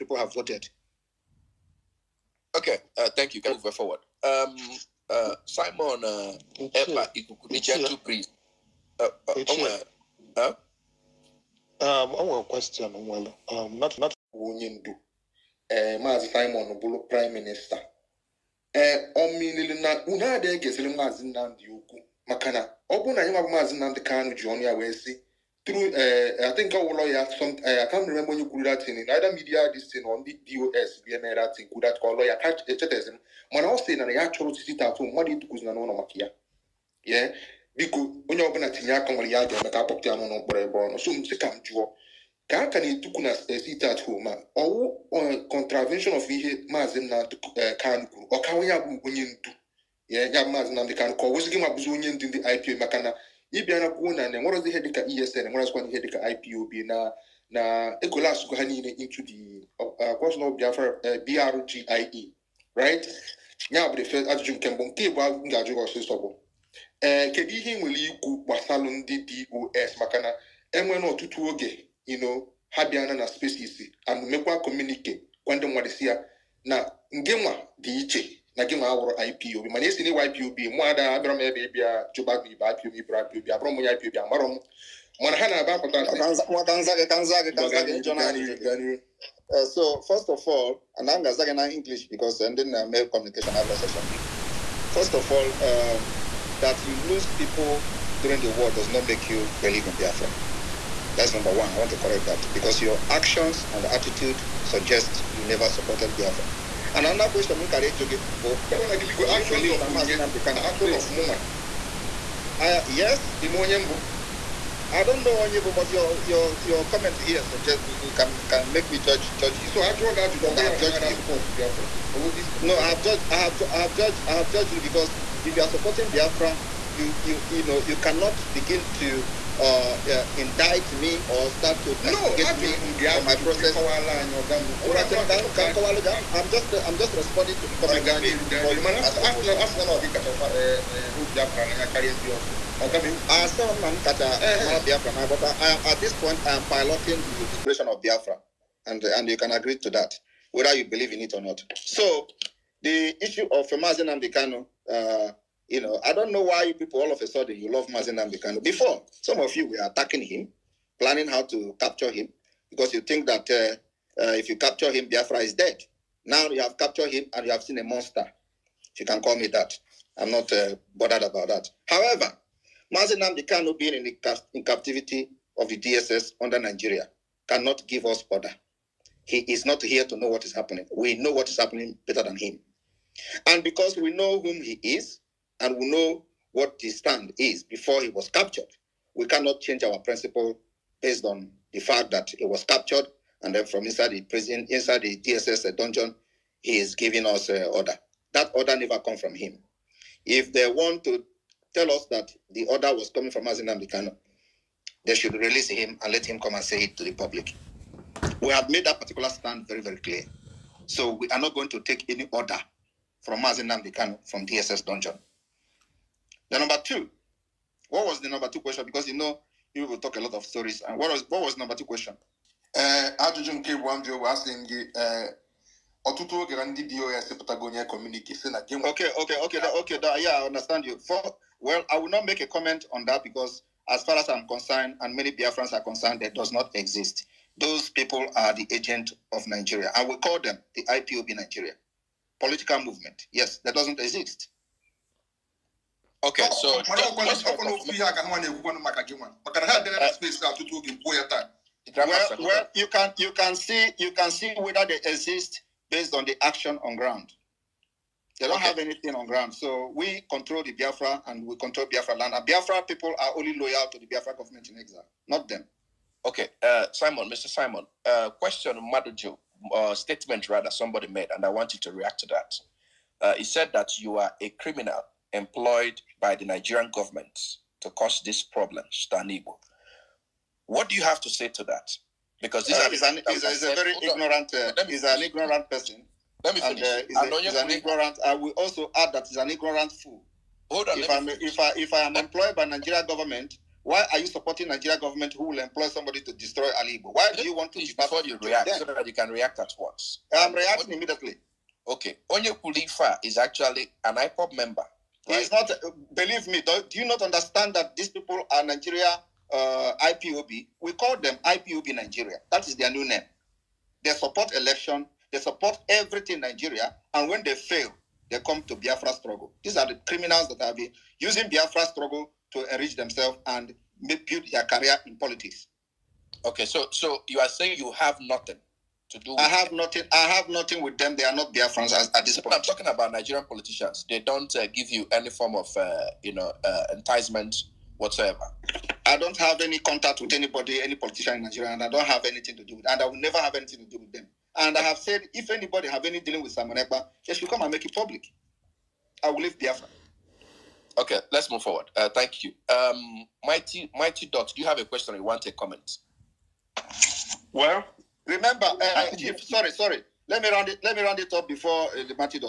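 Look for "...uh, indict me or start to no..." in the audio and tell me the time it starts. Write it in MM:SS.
02:10.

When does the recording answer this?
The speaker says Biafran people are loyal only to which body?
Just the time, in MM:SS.
04:24.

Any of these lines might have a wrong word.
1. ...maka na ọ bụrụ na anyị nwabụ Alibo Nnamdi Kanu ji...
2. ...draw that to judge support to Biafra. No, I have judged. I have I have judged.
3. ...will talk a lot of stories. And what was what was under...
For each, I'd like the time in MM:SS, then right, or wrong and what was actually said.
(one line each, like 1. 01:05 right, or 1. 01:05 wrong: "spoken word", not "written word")
1. 00:22 wrong: "Maazị", not "Alibo"
2. 01:59 right
3. 03:39 wrong: "number", not "under".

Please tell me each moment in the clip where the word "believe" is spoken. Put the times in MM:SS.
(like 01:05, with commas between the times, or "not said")
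01:39, 02:30, 05:06.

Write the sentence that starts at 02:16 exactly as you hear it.
I'm just I'm just responding to the comment.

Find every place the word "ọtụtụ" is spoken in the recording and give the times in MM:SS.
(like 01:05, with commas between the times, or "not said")
01:11, 03:46.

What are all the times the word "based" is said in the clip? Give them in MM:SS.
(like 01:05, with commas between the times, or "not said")
03:11, 04:15.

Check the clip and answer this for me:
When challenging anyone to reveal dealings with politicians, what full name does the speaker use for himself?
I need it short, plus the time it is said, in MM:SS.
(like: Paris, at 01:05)
Simon Ekpa, at 05:46.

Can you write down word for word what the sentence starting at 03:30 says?
So we are not going to take any order from Mazi Nnamdi Kanu from DSS dungeon.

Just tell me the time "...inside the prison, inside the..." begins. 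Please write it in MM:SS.
03:13.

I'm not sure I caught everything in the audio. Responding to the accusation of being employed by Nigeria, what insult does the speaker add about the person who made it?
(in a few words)
ignorant fool.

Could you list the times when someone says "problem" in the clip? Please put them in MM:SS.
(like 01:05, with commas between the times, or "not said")
04:38.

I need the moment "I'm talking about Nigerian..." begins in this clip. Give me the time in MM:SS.
05:32.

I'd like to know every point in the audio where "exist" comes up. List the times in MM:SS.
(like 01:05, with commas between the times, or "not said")
03:56, 04:04, 04:15.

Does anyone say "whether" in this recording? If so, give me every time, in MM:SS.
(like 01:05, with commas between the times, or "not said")
02:30, 04:14.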